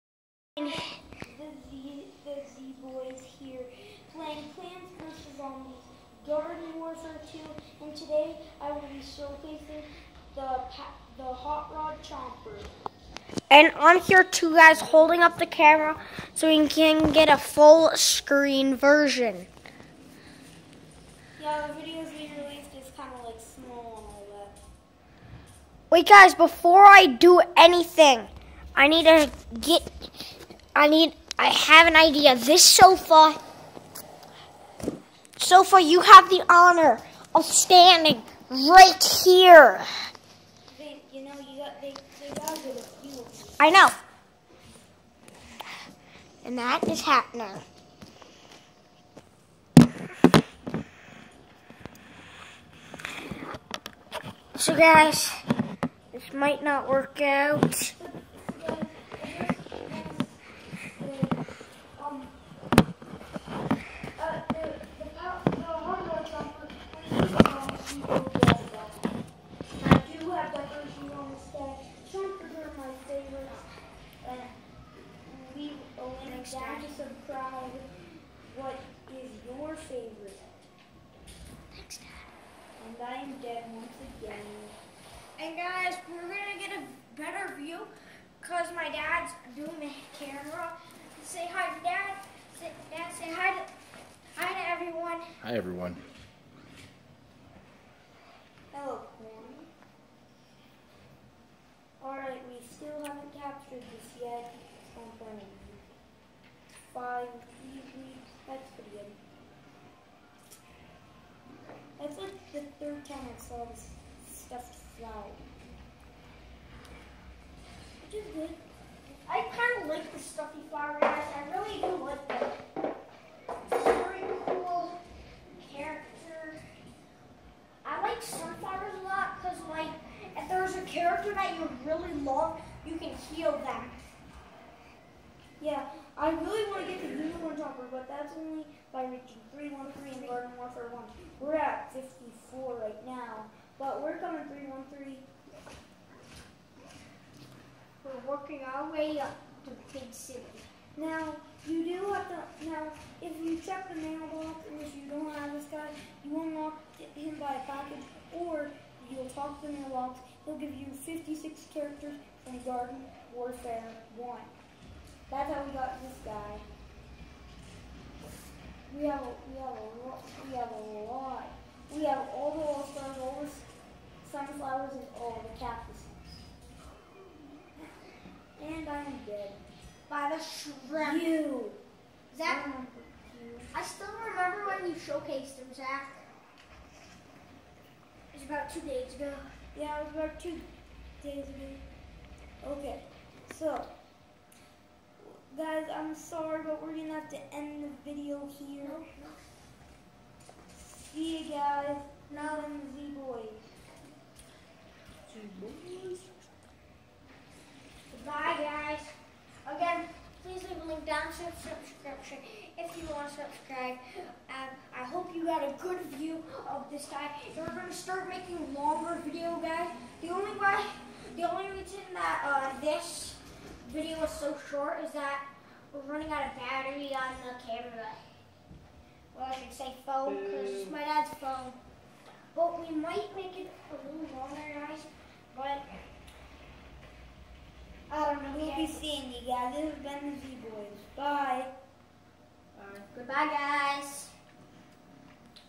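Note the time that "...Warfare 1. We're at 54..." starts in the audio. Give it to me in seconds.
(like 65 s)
140 s.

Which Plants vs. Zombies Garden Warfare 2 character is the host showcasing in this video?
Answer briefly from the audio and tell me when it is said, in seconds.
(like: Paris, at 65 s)
Hot rod chomper, at 11 s.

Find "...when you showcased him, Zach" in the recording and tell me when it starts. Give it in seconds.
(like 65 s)
184 s.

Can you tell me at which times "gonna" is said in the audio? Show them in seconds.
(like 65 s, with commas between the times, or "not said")
86 s, 196 s, 217 s.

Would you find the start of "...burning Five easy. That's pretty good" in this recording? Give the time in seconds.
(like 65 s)
105 s.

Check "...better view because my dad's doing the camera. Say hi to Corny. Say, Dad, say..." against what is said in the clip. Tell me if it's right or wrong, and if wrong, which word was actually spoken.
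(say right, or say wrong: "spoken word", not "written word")
wrong: "Dad", not "Corny".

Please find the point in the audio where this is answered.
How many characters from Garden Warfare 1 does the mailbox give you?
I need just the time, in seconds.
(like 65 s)
161 s.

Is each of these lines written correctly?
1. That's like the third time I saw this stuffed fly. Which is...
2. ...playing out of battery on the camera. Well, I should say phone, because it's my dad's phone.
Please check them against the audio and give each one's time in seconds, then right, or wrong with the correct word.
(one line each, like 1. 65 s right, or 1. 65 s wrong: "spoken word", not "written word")
1. 112 s right
2. 226 s wrong: "running", not "playing".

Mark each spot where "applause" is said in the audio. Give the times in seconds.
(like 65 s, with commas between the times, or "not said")
not said.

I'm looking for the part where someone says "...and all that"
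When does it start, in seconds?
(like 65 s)
24 s.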